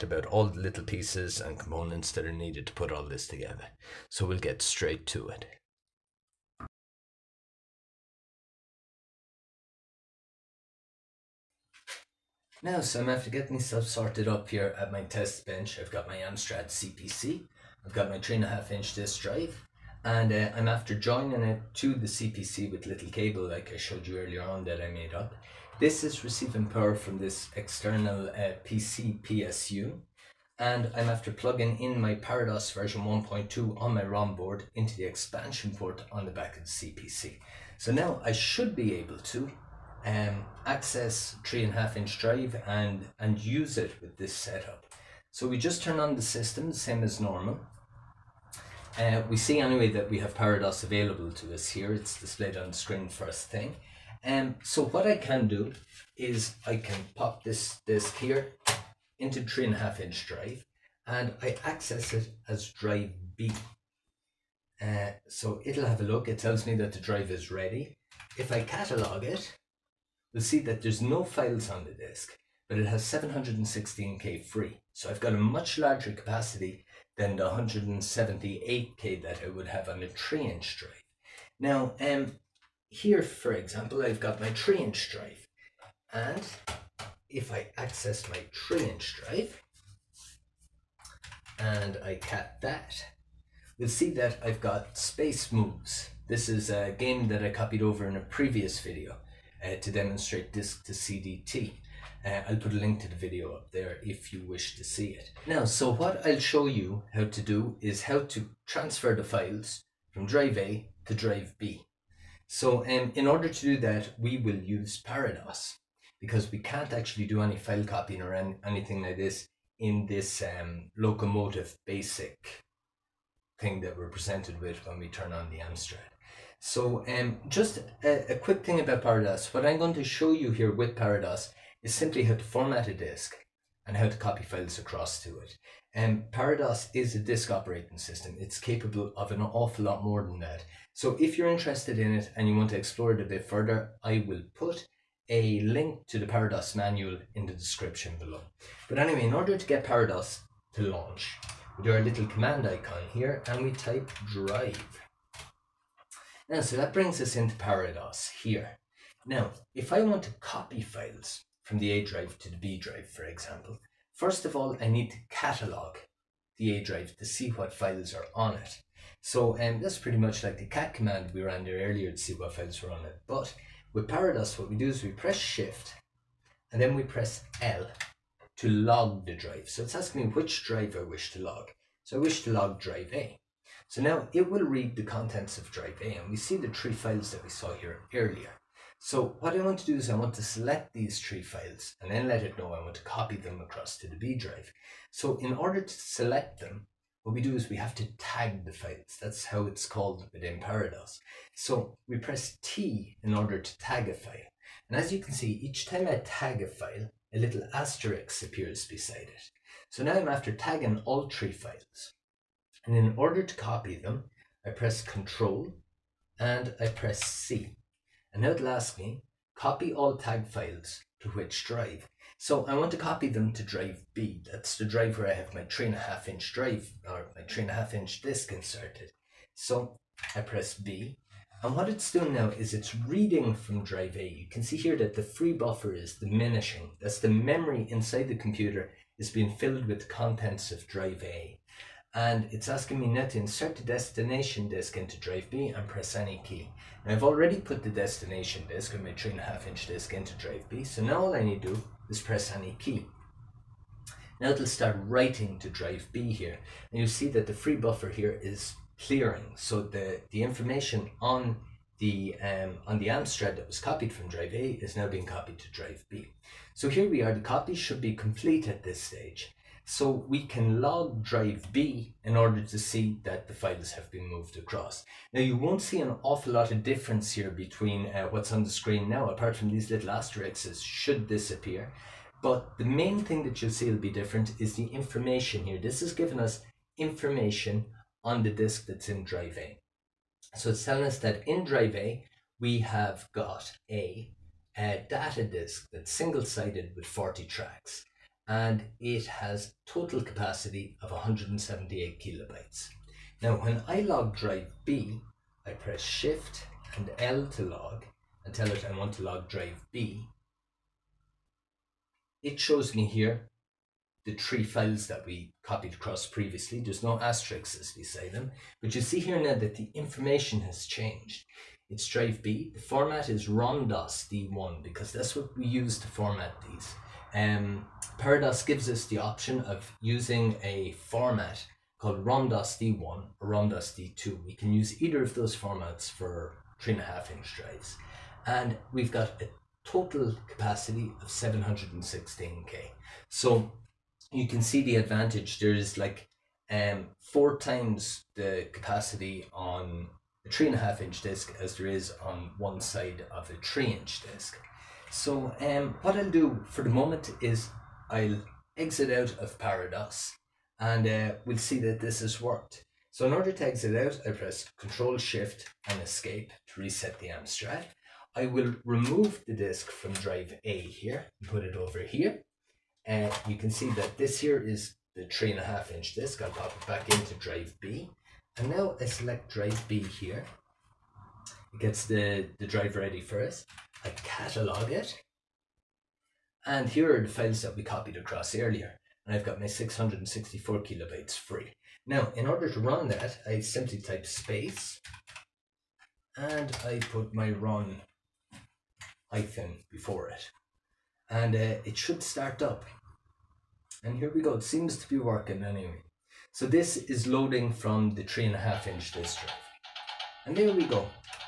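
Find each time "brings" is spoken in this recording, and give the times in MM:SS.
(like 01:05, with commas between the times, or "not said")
02:36.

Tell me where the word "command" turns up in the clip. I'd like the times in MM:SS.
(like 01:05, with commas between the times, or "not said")
02:32, 02:50.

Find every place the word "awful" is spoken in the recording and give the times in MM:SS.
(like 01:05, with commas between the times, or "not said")
02:19, 04:36.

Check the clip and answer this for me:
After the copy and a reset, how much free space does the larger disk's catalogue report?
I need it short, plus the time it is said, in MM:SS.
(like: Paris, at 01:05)
664 kilobytes, at 06:29.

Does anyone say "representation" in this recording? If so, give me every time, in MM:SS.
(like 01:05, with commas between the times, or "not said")
not said.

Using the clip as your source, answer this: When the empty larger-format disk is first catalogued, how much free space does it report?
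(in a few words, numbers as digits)
716K.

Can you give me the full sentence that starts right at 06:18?
And now I select drive B here.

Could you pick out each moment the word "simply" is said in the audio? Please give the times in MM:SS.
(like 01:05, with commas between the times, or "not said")
02:11, 06:33.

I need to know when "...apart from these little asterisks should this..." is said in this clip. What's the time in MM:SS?
04:39.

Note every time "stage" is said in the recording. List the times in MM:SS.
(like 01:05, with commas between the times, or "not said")
04:28.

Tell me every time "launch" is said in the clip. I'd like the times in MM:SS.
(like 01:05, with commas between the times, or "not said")
02:30.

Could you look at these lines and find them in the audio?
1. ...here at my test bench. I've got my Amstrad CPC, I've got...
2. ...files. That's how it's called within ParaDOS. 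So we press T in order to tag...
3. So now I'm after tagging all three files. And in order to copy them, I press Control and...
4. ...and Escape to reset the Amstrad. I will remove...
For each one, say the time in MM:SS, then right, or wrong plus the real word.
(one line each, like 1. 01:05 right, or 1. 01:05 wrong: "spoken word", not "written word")
1. 00:14 right
2. 03:18 right
3. 03:29 right
4. 06:05 right.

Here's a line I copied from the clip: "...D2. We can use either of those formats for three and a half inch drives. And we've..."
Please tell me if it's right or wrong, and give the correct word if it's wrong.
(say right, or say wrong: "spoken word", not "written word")
right.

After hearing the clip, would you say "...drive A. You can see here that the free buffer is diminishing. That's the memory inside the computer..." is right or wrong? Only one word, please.
right.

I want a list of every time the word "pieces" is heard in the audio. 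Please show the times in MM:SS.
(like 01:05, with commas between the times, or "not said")
00:00.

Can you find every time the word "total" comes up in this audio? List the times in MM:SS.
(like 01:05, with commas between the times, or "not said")
04:59, 05:39.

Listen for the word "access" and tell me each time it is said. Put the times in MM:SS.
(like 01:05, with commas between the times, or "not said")
00:40, 01:01, 01:27.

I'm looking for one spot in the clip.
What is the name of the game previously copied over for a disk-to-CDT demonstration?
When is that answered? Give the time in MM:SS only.
01:34.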